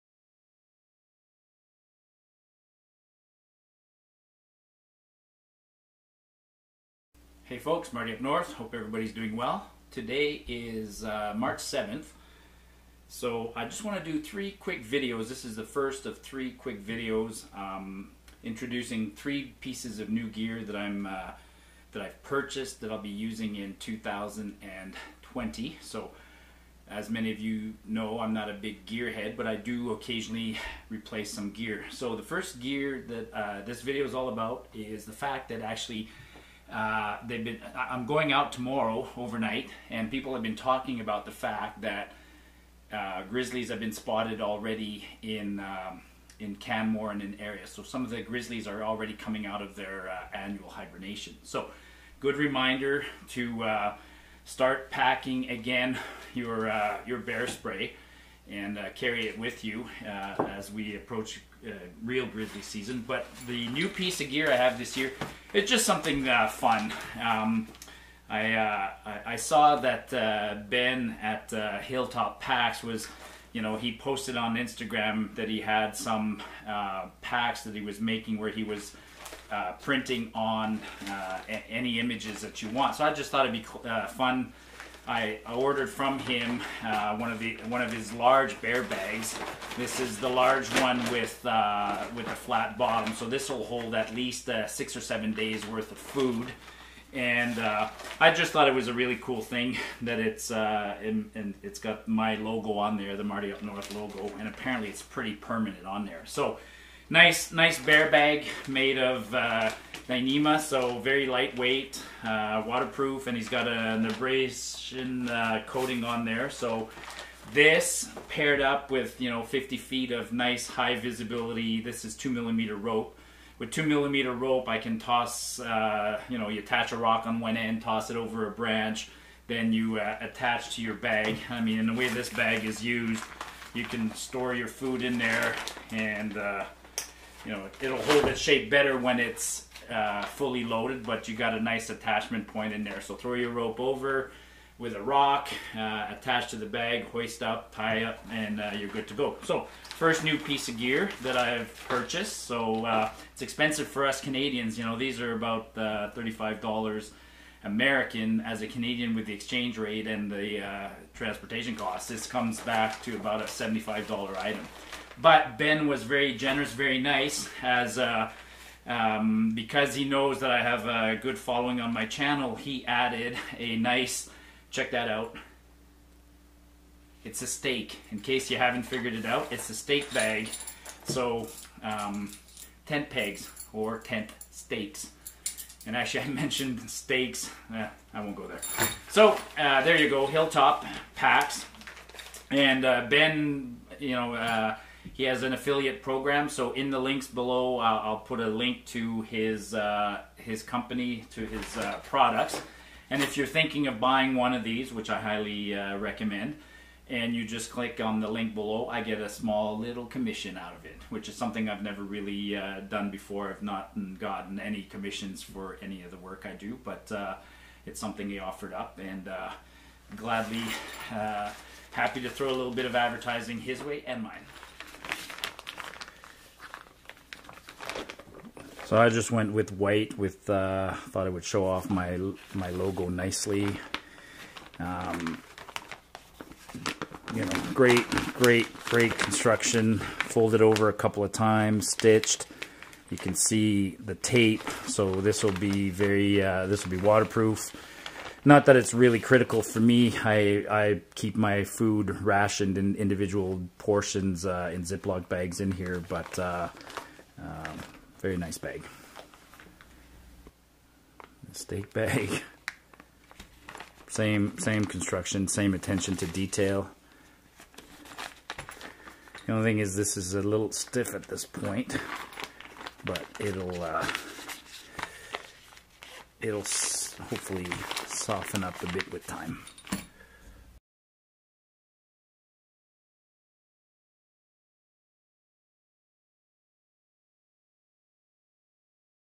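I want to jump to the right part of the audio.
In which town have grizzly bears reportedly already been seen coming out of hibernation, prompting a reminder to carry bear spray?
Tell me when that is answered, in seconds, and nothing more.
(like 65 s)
46 s.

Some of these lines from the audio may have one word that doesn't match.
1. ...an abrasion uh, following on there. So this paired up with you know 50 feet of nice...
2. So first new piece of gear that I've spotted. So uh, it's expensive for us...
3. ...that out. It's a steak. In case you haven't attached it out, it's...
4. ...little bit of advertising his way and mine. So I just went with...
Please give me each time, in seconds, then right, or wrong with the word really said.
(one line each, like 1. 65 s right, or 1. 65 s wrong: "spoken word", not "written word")
1. 113 s wrong: "coating", not "following"
2. 149 s wrong: "purchased", not "spotted"
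3. 174 s wrong: "figured", not "attached"
4. 222 s right.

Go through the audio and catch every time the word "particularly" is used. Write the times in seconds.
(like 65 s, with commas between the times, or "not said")
not said.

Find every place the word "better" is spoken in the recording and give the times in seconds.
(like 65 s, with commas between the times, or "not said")
138 s.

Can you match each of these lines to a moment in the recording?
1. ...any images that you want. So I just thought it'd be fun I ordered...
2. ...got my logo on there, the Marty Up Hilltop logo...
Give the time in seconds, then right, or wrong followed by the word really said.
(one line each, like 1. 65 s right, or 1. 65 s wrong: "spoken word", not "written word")
1. 81 s right
2. 101 s wrong: "North", not "Hilltop".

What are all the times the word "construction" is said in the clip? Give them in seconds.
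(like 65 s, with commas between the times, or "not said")
239 s, 264 s.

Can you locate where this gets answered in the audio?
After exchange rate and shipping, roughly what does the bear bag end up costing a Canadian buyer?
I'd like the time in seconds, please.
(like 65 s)
163 s.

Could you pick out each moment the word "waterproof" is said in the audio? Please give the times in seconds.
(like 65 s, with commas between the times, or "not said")
112 s, 247 s.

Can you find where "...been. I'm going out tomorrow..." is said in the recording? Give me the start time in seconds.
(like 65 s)
37 s.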